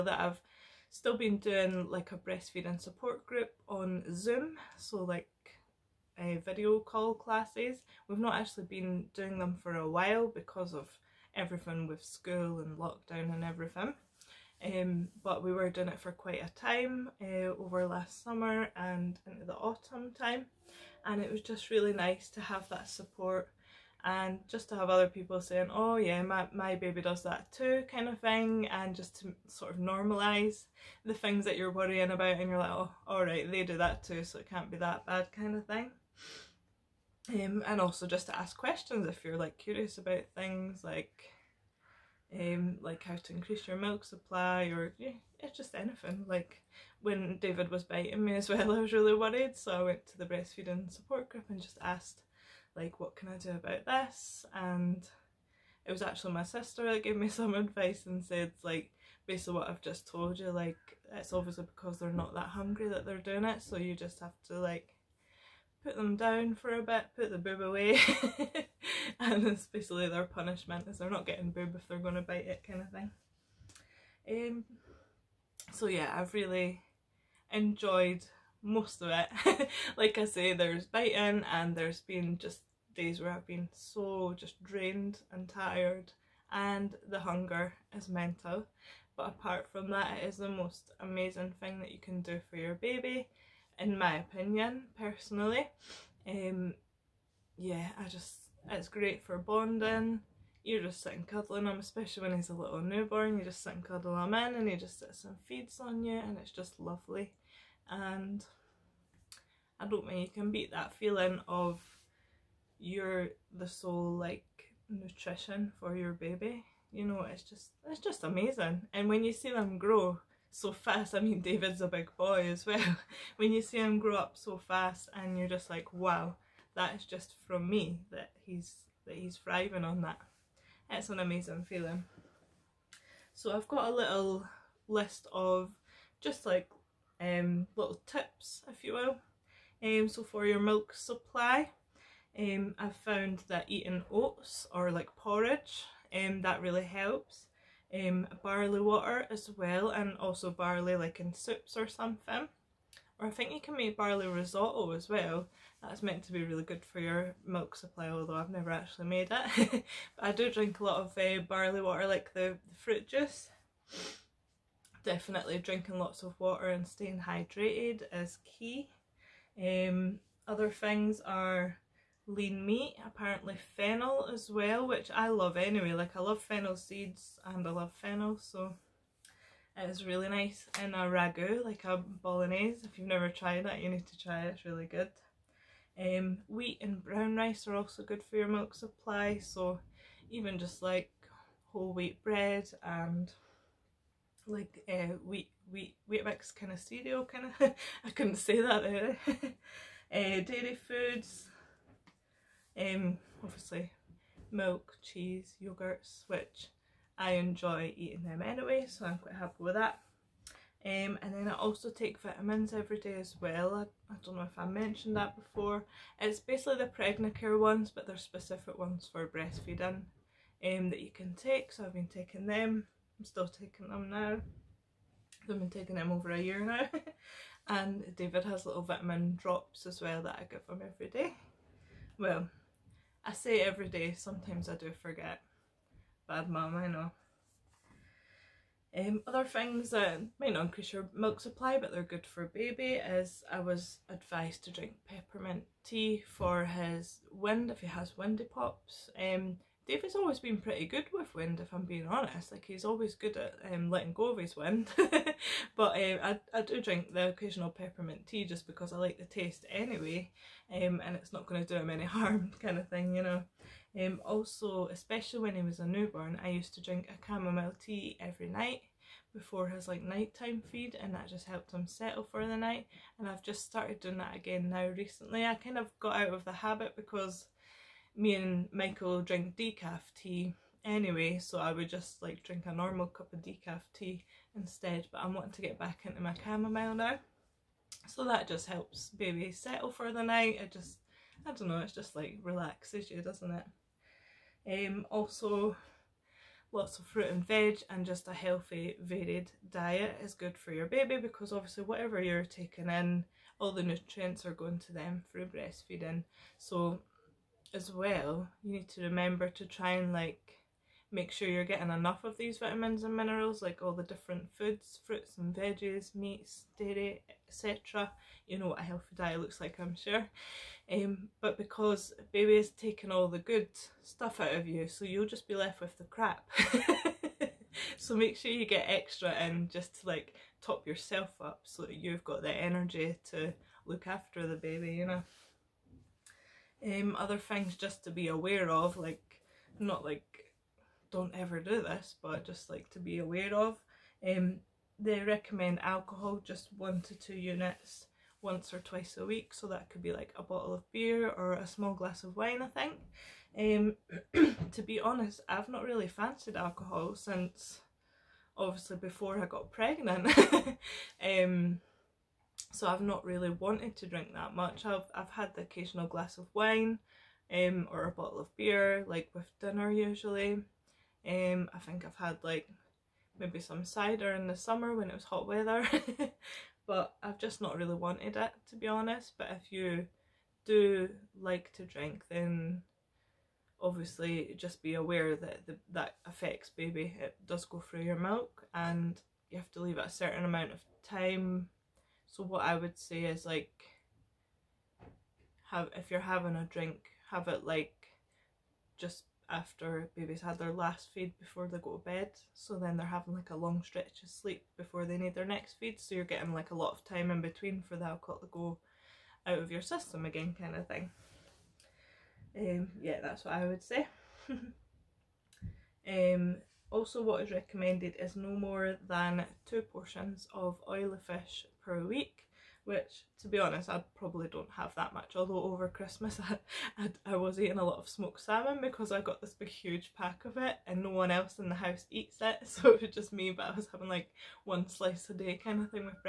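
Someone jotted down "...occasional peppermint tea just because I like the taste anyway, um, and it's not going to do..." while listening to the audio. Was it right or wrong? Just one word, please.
right.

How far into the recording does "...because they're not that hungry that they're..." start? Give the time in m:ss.
1:01.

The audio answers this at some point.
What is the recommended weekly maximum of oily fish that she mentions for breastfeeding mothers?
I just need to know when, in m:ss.
6:59.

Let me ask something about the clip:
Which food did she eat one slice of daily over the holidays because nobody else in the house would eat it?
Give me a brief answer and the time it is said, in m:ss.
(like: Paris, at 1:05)
Smoked salmon, at 7:08.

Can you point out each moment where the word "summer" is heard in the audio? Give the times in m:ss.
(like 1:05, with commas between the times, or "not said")
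0:18, 6:14.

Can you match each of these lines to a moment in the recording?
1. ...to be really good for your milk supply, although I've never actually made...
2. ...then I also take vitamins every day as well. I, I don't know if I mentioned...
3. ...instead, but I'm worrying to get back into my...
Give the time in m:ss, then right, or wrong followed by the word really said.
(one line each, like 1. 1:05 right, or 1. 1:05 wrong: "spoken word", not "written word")
1. 2:36 right
2. 3:31 right
3. 4:44 wrong: "wanting", not "worrying".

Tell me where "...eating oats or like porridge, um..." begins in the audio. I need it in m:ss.
2:23.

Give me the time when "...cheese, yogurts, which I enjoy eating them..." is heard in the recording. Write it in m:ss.
3:25.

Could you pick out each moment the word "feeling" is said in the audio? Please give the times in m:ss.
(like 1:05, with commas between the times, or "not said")
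1:50, 2:11.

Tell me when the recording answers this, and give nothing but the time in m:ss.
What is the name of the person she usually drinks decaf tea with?
4:38.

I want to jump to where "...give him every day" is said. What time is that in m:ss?
3:50.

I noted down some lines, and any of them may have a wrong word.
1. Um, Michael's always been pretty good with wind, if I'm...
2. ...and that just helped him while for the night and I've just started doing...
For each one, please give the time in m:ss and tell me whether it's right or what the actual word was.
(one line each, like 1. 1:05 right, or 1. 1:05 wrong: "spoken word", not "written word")
1. 4:09 wrong: "David", not "Michael"
2. 4:30 wrong: "settle", not "while".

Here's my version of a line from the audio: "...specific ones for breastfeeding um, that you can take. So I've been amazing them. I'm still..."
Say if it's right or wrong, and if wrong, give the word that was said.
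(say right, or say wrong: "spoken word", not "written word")
wrong: "taking", not "amazing".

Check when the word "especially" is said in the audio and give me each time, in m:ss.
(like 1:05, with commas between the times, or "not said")
1:09, 1:41, 4:24.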